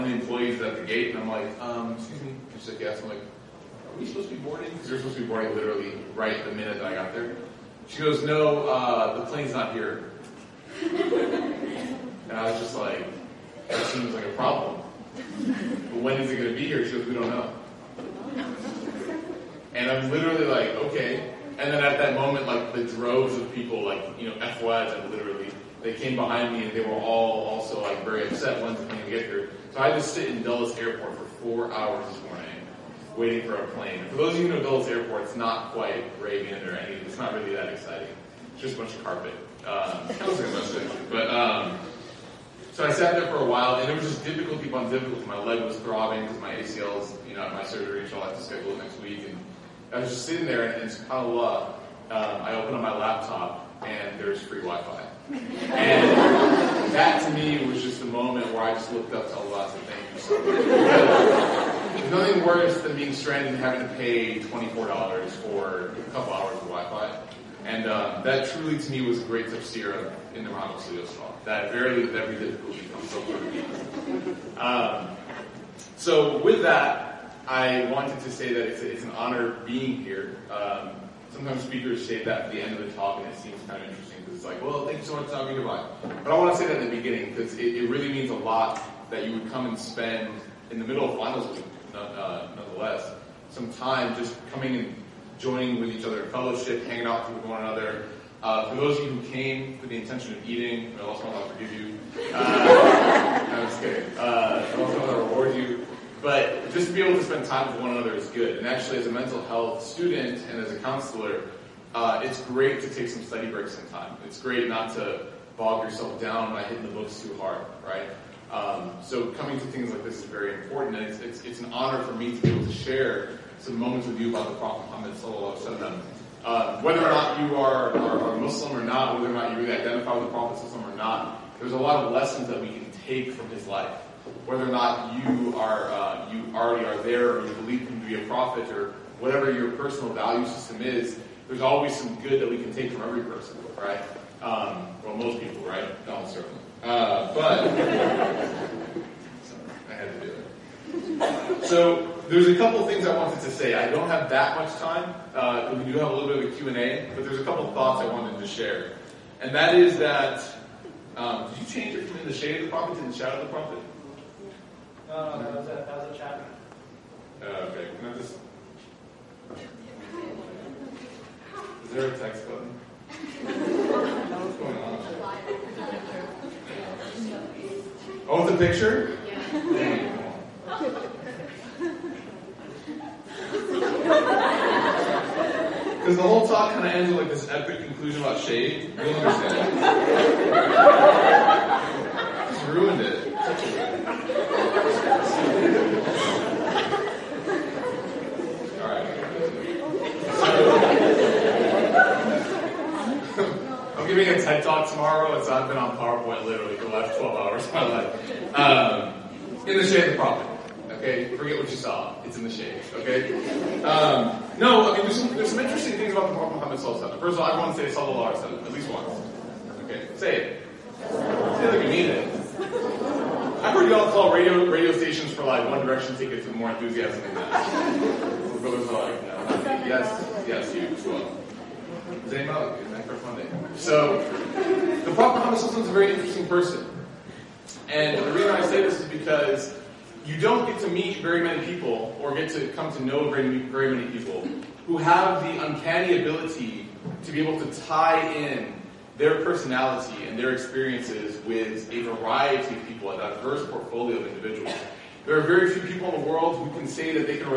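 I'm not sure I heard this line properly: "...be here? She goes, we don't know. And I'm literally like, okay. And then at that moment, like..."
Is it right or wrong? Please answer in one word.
right.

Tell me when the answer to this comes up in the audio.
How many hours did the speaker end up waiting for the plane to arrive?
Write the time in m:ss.
0:31.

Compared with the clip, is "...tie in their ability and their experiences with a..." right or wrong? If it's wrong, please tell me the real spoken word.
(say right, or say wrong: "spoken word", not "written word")
wrong: "personality", not "ability".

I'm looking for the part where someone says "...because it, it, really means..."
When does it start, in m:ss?
1:27.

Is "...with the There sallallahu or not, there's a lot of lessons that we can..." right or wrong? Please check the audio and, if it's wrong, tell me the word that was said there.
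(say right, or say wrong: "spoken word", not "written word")
wrong: "Prophet", not "There".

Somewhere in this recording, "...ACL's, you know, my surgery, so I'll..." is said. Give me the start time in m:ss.
0:46.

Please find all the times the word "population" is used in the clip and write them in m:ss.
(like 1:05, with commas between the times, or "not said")
not said.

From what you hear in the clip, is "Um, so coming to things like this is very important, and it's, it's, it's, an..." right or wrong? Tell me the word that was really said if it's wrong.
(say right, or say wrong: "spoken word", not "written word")
right.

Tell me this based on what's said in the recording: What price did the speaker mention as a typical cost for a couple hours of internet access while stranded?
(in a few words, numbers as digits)
$24.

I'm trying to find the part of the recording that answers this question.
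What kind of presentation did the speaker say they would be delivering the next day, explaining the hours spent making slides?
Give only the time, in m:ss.
3:24.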